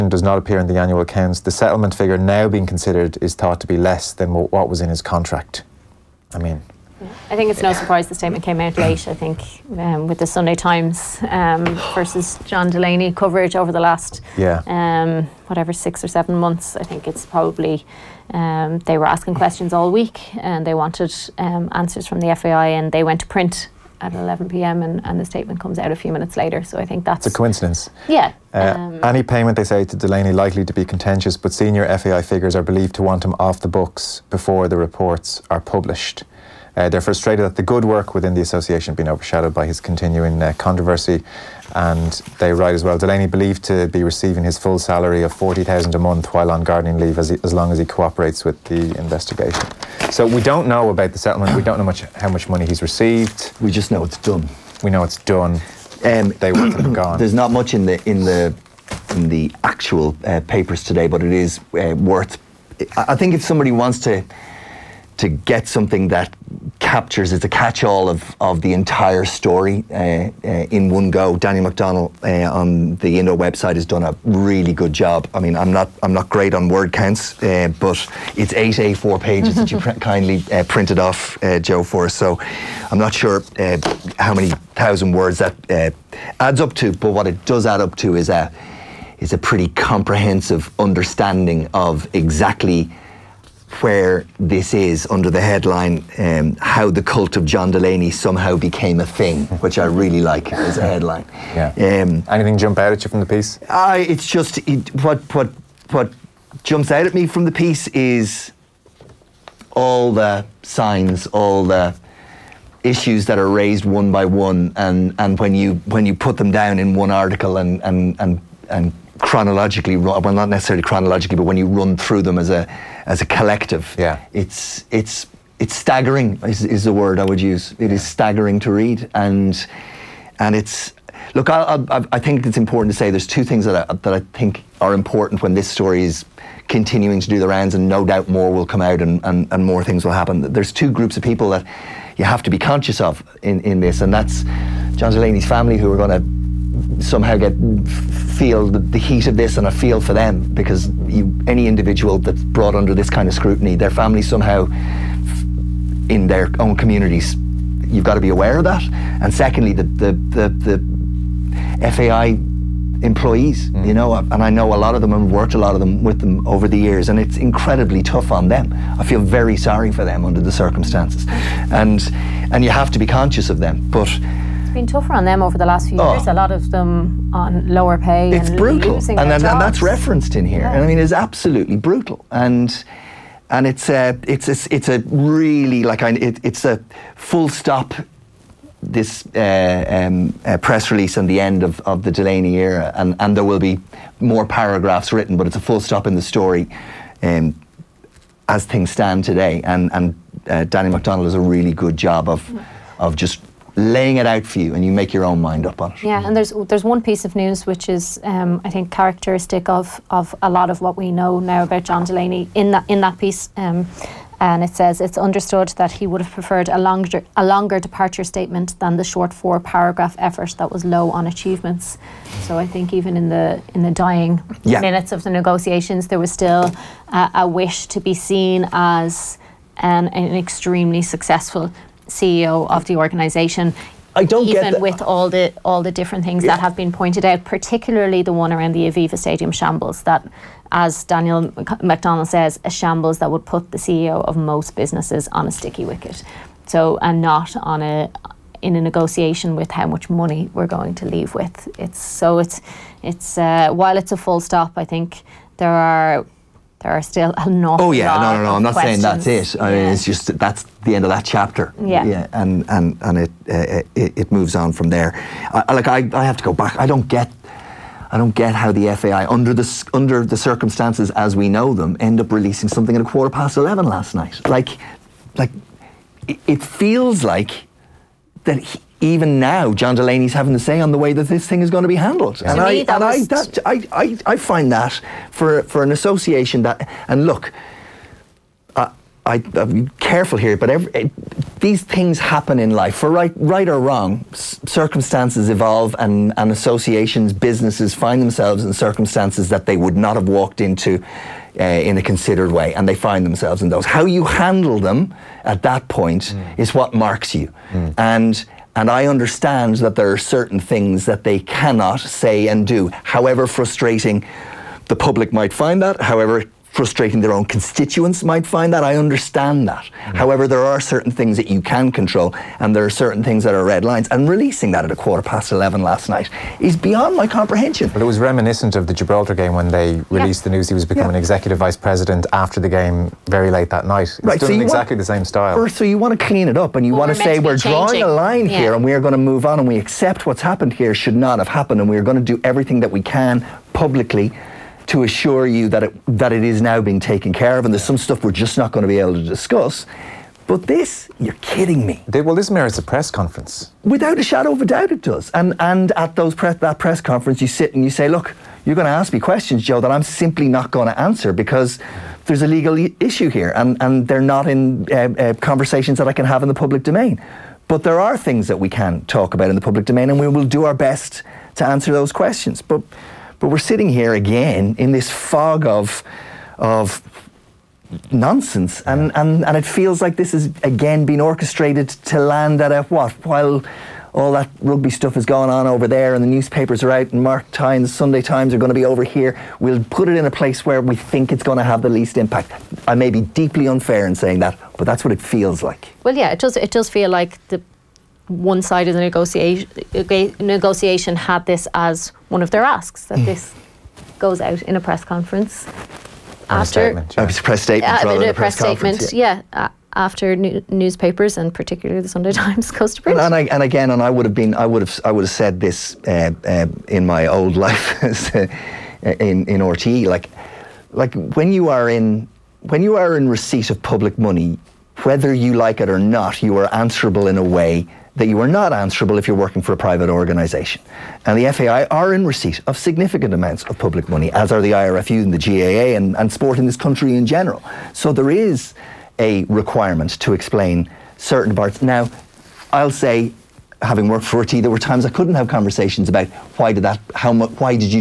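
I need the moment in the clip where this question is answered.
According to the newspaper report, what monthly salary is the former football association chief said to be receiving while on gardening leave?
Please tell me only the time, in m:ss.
0:45.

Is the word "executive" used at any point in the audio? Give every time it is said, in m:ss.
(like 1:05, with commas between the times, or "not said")
5:31.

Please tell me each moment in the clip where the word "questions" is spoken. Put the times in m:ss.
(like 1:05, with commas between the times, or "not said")
0:19, 4:18, 5:59, 6:12.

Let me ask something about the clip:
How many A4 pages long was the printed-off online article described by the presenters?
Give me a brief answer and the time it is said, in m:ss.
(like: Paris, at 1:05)
eight, at 1:18.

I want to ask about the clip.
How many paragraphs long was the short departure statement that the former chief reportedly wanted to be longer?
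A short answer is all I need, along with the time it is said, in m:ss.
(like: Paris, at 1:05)
four, at 3:39.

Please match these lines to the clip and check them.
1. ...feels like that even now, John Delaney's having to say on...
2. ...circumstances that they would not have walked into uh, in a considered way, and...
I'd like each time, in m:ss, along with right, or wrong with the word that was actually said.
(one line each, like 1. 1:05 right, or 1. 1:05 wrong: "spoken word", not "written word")
1. 4:36 right
2. 4:58 right.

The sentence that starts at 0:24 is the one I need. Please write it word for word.
And, and the statement comes out a few minutes later.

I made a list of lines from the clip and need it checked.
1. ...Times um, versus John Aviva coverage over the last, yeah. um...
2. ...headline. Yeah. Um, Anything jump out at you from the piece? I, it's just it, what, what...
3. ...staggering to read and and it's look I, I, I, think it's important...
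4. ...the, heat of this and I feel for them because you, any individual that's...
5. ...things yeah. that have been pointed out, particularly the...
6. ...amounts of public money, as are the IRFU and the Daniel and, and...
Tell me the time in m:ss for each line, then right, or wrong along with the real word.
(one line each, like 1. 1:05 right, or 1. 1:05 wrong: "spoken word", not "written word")
1. 0:10 wrong: "Delaney", not "Aviva"
2. 1:40 right
3. 2:08 right
4. 2:28 right
5. 3:56 right
6. 7:13 wrong: "GAA", not "Daniel".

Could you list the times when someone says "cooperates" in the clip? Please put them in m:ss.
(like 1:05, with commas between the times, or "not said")
0:47.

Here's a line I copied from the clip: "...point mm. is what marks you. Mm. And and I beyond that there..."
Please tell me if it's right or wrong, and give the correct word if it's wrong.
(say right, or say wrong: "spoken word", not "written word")
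wrong: "understand", not "beyond".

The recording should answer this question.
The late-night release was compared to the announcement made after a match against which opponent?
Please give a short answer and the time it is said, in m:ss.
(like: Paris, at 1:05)
Gibraltar, at 5:28.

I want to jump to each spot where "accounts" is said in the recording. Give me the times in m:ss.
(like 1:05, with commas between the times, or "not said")
0:00.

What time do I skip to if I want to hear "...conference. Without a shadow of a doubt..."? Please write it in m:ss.
5:53.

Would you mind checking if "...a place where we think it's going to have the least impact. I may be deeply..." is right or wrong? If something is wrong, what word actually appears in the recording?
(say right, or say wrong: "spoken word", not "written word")
right.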